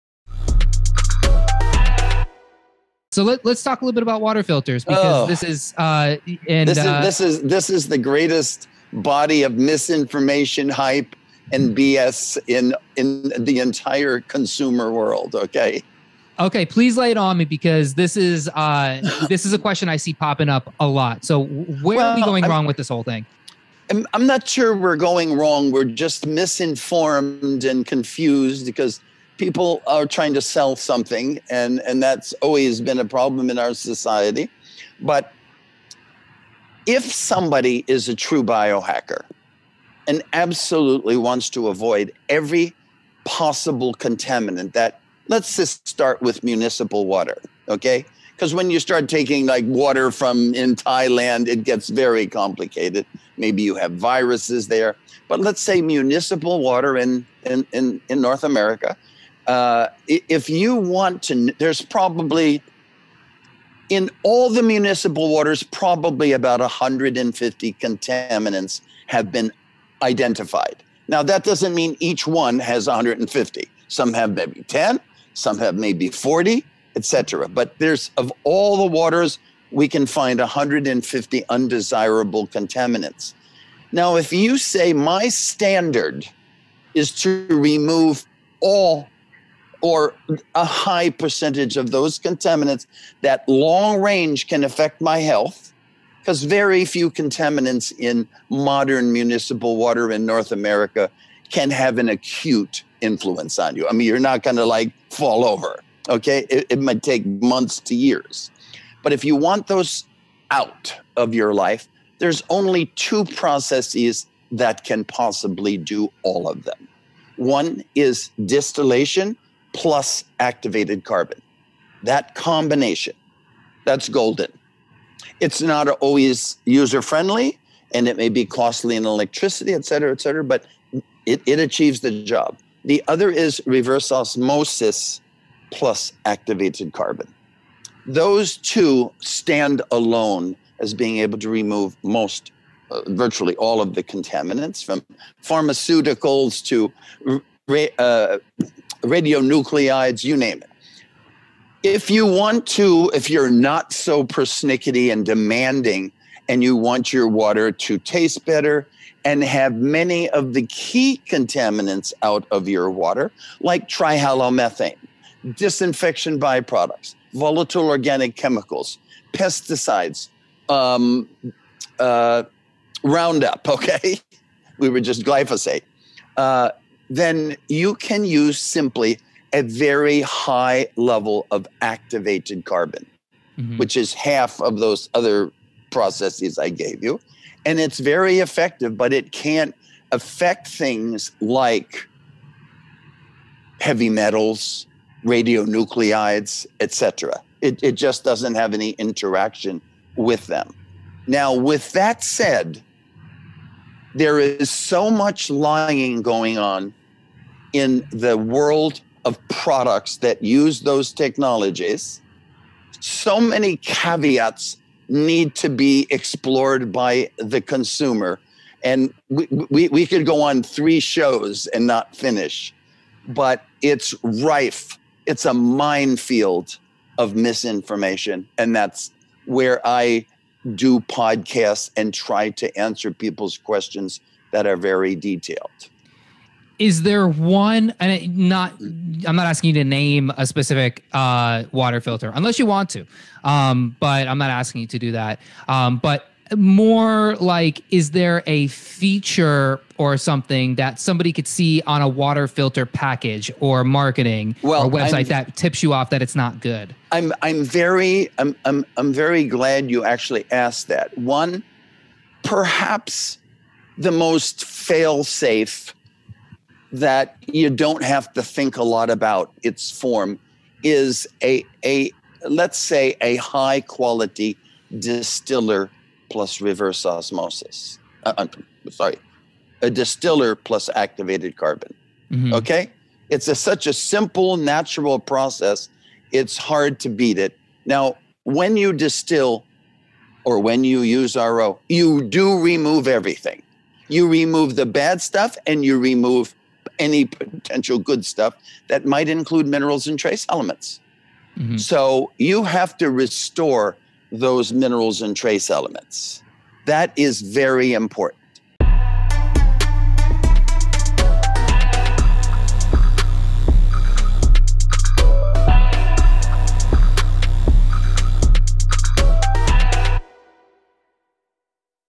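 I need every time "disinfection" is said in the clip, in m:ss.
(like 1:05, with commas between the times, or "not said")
2:45.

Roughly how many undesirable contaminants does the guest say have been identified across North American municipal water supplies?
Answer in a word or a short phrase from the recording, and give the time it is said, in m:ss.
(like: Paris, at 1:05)
150, at 1:06.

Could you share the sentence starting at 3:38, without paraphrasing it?
And we, we, we could go on three shows and not finish, but it's rife.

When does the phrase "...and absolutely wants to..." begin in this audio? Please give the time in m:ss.
0:40.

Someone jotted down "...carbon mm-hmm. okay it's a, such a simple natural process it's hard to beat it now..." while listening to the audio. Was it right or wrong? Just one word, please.
right.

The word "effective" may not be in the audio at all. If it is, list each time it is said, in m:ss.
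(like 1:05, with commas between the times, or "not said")
3:08.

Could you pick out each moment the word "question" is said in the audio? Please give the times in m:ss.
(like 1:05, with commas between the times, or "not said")
0:19, 3:53.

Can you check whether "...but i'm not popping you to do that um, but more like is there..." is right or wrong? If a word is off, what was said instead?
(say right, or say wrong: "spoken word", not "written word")
wrong: "asking", not "popping".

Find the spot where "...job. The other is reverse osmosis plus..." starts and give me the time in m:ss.
2:12.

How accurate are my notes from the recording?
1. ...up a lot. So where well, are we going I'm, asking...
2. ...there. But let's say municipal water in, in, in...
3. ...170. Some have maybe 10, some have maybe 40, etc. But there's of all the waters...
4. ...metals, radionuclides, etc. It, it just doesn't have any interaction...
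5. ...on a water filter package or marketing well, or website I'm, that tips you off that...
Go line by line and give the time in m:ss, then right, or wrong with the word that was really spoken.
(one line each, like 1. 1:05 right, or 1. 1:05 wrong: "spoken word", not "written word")
1. 0:20 wrong: "wrong", not "asking"
2. 0:54 right
3. 1:12 wrong: "150", not "170"
4. 3:14 right
5. 4:11 right.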